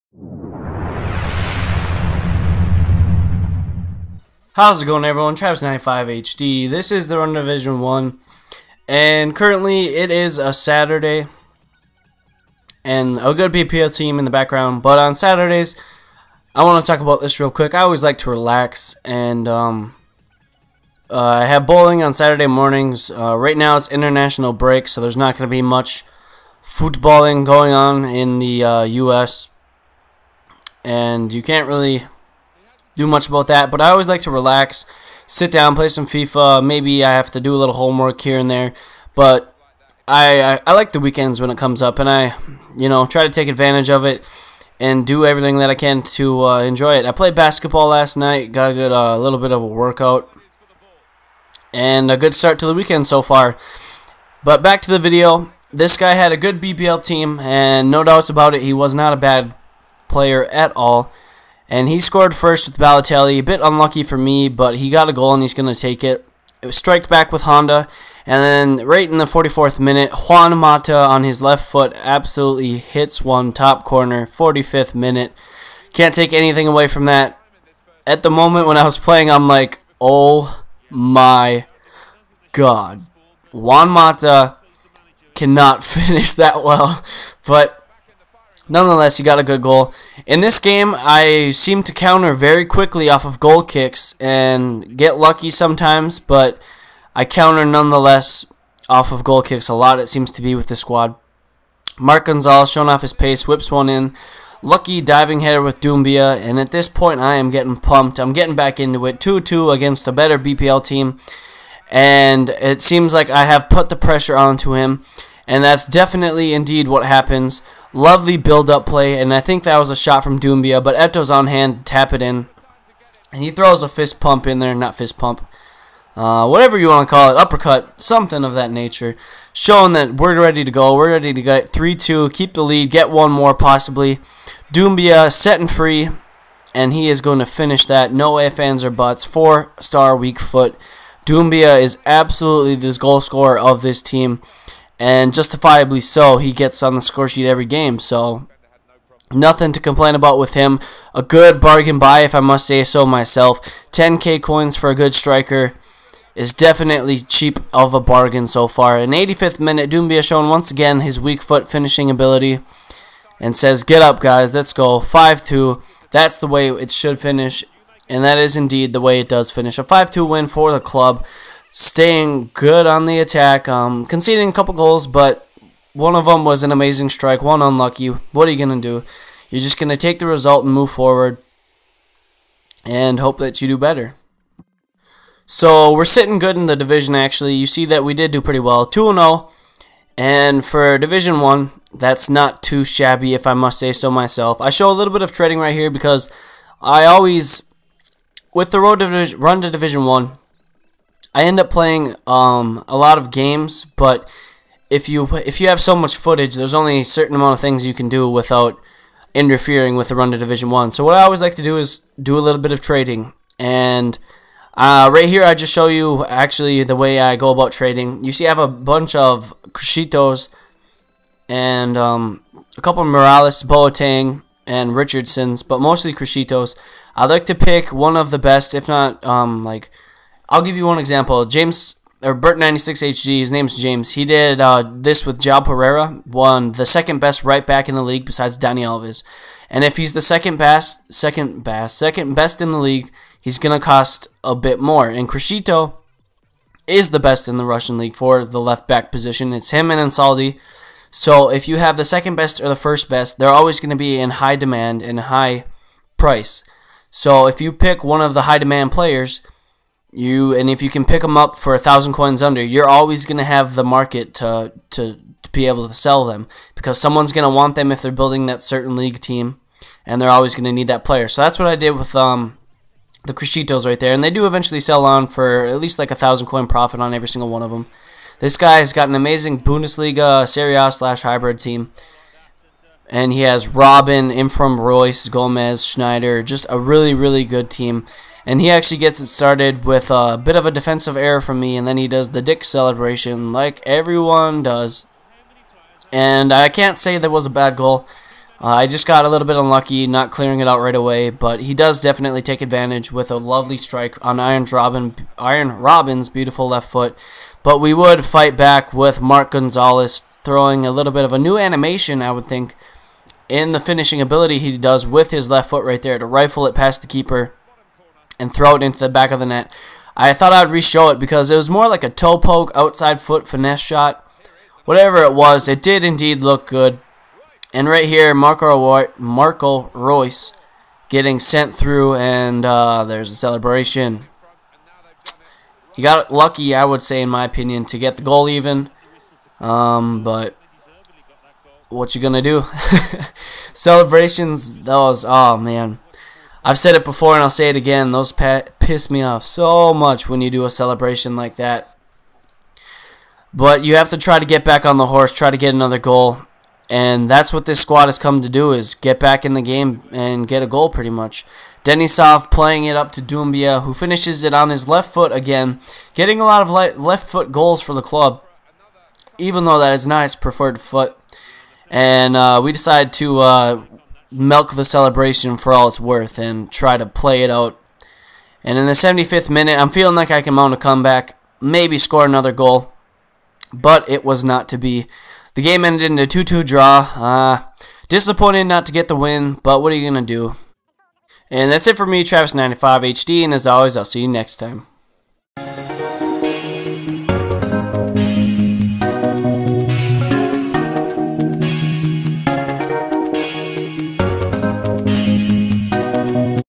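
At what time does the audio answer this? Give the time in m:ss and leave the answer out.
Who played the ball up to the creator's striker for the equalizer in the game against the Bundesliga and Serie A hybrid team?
6:01.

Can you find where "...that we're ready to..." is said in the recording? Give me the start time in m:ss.
2:09.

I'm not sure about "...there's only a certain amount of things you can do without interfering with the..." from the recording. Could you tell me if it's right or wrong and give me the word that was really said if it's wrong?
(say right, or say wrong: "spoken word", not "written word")
right.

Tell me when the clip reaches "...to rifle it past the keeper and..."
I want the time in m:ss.
5:16.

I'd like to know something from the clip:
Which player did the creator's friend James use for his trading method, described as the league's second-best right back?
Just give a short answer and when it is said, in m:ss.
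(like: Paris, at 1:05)
João Pereira, at 3:55.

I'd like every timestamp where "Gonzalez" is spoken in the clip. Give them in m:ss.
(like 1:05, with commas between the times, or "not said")
1:42, 5:09.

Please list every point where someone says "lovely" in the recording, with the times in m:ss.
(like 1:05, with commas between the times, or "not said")
1:57, 5:03.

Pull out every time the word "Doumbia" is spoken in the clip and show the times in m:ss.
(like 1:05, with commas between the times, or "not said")
1:45, 2:00, 2:14, 2:21, 2:39, 6:03.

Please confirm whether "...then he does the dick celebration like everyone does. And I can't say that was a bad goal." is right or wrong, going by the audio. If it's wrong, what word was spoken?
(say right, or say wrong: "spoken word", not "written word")
right.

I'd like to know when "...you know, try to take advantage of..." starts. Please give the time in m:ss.
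0:42.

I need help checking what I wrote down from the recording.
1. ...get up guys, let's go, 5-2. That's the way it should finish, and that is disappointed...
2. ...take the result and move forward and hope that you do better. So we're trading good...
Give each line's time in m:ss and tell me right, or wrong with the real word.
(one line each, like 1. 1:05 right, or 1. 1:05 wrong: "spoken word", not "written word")
1. 2:43 wrong: "indeed", not "disappointed"
2. 2:59 wrong: "sitting", not "trading".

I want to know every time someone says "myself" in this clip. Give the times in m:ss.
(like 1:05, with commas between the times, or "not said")
2:33, 3:14.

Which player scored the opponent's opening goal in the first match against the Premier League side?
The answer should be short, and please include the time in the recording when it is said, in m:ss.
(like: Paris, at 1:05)
Balotelli, at 1:02.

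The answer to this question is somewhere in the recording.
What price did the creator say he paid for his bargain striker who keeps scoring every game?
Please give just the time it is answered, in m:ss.
2:33.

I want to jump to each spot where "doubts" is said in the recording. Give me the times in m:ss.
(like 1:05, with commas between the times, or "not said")
0:58.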